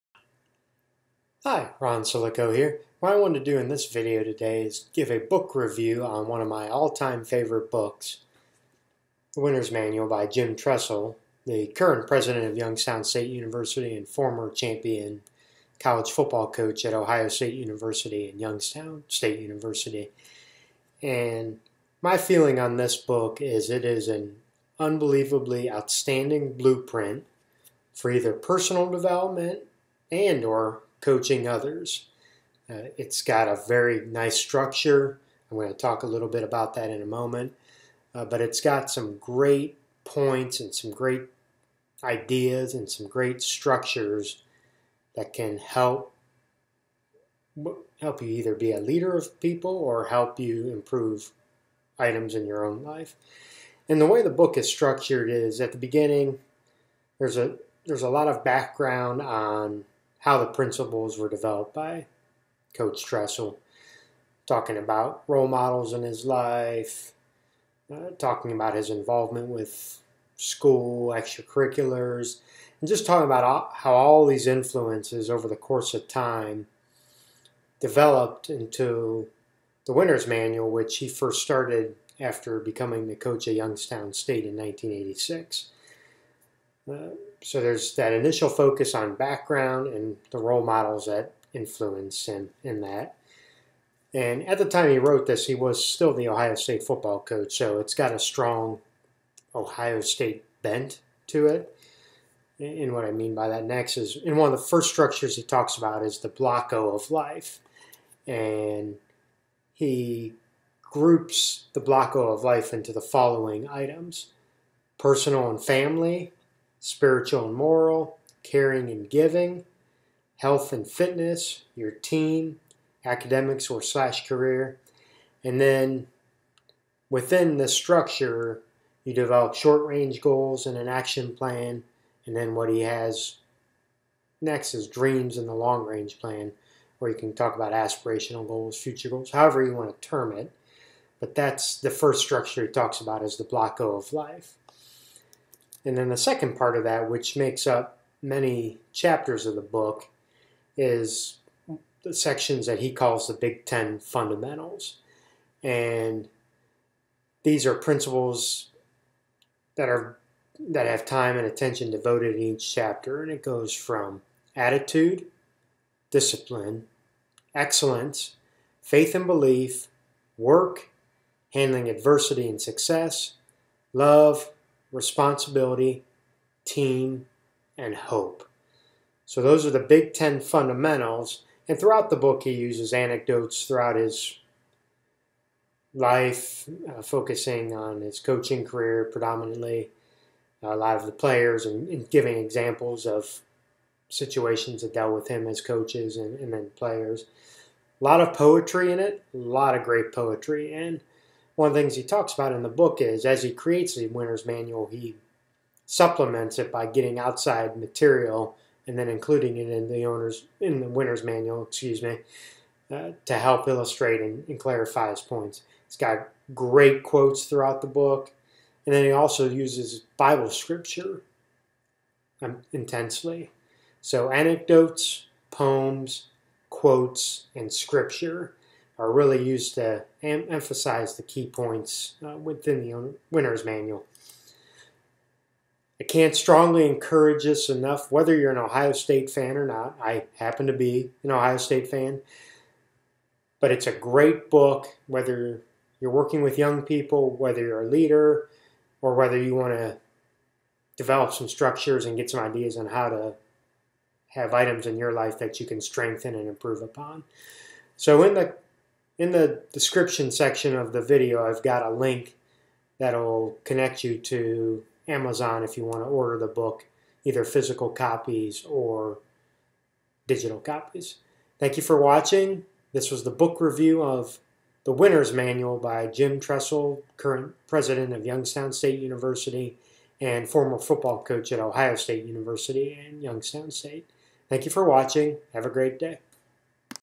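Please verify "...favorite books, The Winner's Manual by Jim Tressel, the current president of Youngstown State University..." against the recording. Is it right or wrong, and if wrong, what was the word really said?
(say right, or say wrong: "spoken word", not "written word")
right.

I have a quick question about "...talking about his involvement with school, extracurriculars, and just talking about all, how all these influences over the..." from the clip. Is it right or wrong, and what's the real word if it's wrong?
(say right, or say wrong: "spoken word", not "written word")
right.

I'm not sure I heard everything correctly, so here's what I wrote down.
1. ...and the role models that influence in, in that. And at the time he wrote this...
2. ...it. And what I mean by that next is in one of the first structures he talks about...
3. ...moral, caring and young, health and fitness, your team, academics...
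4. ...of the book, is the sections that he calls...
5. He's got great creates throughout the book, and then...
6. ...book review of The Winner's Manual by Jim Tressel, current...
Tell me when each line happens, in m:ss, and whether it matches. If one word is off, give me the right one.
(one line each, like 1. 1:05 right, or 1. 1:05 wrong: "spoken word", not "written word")
1. 1:29 right
2. 1:41 right
3. 1:57 wrong: "giving", not "young"
4. 2:29 right
5. 3:35 wrong: "quotes", not "creates"
6. 4:33 right.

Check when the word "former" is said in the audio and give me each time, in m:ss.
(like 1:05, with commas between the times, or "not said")
0:14, 4:40.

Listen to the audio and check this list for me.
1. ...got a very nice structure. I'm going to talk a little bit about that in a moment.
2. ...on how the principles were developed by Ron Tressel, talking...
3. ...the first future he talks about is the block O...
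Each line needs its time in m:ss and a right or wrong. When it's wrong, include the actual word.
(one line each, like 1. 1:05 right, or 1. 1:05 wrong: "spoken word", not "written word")
1. 0:33 right
2. 0:59 wrong: "Coach", not "Ron"
3. 2:21 wrong: "structure", not "future".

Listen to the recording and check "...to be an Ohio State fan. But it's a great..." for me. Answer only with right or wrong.
right.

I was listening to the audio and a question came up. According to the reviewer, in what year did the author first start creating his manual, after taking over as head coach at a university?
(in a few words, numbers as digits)
1986.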